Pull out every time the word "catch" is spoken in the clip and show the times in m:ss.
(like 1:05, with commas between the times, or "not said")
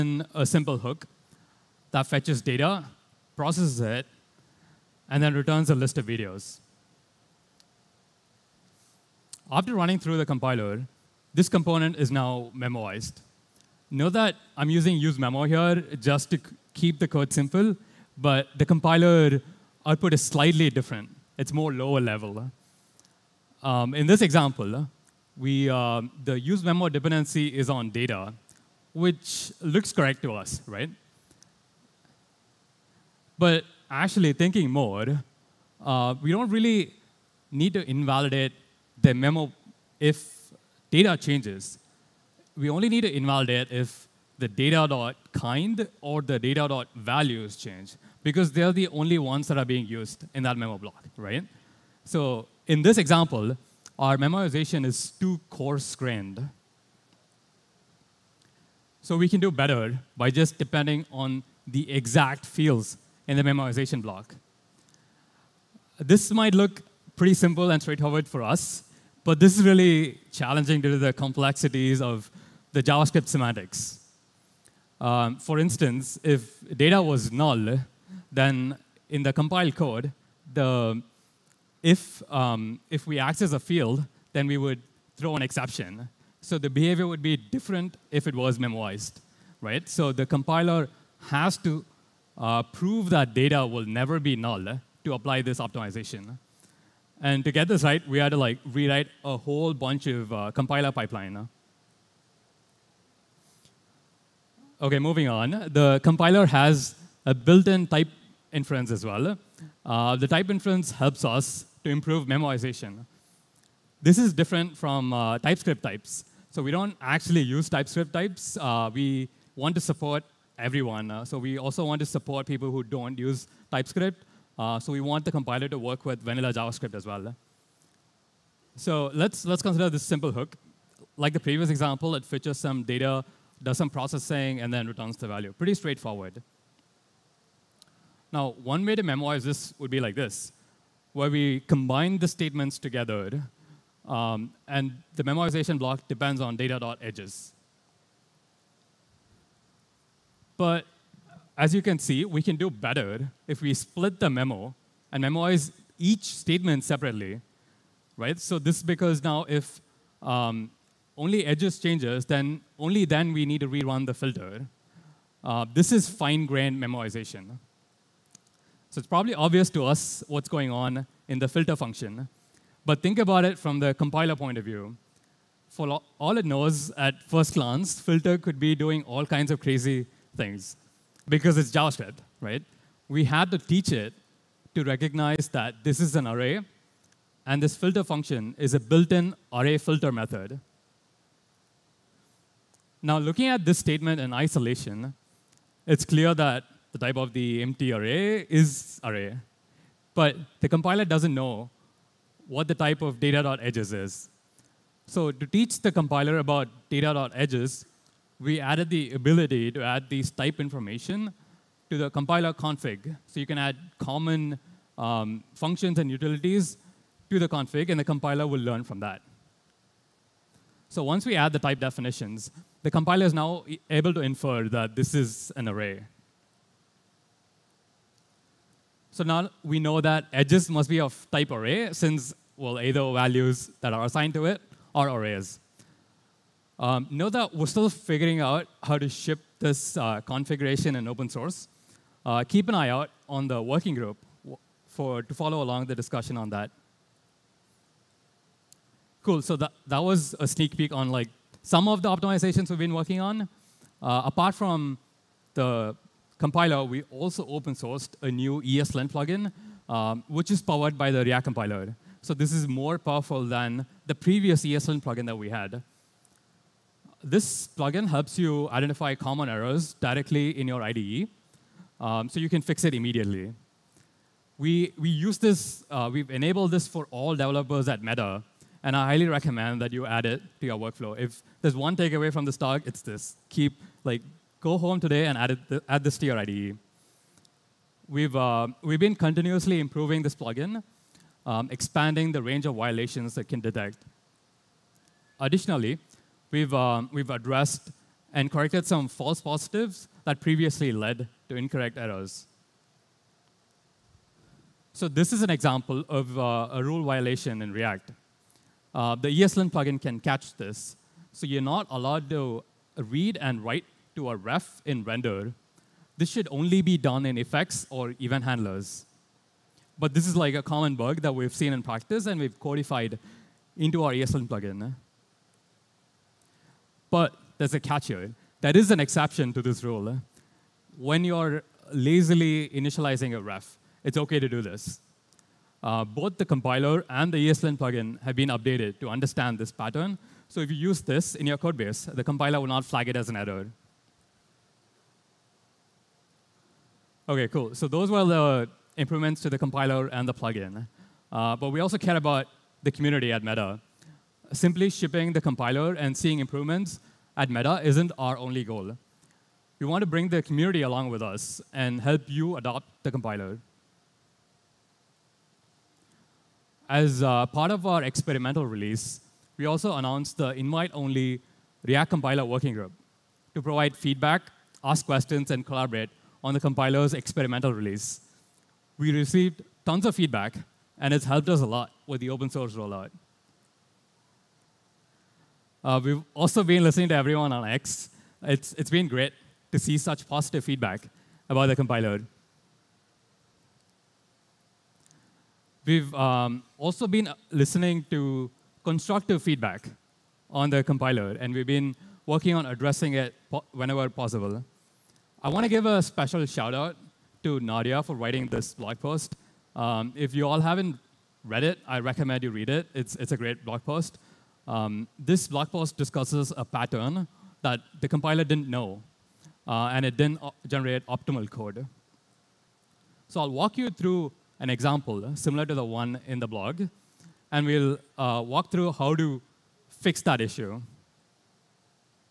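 5:10, 5:27.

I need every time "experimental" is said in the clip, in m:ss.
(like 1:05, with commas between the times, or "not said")
6:08, 6:17.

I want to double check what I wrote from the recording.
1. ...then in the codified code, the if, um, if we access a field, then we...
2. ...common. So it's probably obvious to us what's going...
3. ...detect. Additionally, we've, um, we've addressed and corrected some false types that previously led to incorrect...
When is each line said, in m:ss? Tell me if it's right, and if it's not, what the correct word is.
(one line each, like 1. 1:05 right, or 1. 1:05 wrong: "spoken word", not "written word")
1. 1:18 wrong: "compiled", not "codified"
2. 2:46 wrong: "memoization", not "common"
3. 4:53 wrong: "positives", not "types".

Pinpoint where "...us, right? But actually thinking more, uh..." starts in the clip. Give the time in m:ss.
0:30.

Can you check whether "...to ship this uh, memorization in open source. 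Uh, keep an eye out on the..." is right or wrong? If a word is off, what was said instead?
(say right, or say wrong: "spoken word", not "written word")
wrong: "configuration", not "memorization".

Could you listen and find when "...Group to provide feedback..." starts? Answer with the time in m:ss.
6:12.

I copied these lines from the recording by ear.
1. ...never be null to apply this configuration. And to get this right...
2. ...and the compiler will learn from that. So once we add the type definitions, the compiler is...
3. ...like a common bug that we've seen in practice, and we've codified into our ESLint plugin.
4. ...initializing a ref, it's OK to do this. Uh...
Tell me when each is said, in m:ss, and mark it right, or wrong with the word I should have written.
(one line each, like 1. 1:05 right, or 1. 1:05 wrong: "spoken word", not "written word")
1. 1:33 wrong: "optimization", not "configuration"
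2. 3:37 right
3. 5:20 right
4. 5:32 right.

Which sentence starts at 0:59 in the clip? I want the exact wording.
So we can do better by just depending on the exact fields in the memoization block.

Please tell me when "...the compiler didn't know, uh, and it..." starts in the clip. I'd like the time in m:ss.
6:57.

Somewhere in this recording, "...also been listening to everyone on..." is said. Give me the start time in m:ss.
6:26.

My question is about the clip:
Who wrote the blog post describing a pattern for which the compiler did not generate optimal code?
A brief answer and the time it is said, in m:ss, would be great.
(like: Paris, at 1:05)
Nadia, at 6:47.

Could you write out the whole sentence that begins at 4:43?
Keep, like, go home today and add, it, add this to your IDE.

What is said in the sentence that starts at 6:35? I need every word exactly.
We've um, also been uh, listening to constructive feedback on the compiler, and we've been working on addressing it po whenever possible.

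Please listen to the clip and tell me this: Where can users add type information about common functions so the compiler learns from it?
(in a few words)
the compiler config.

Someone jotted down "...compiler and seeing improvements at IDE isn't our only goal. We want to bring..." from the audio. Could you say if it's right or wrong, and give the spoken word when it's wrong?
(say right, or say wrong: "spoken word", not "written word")
wrong: "Meta", not "IDE".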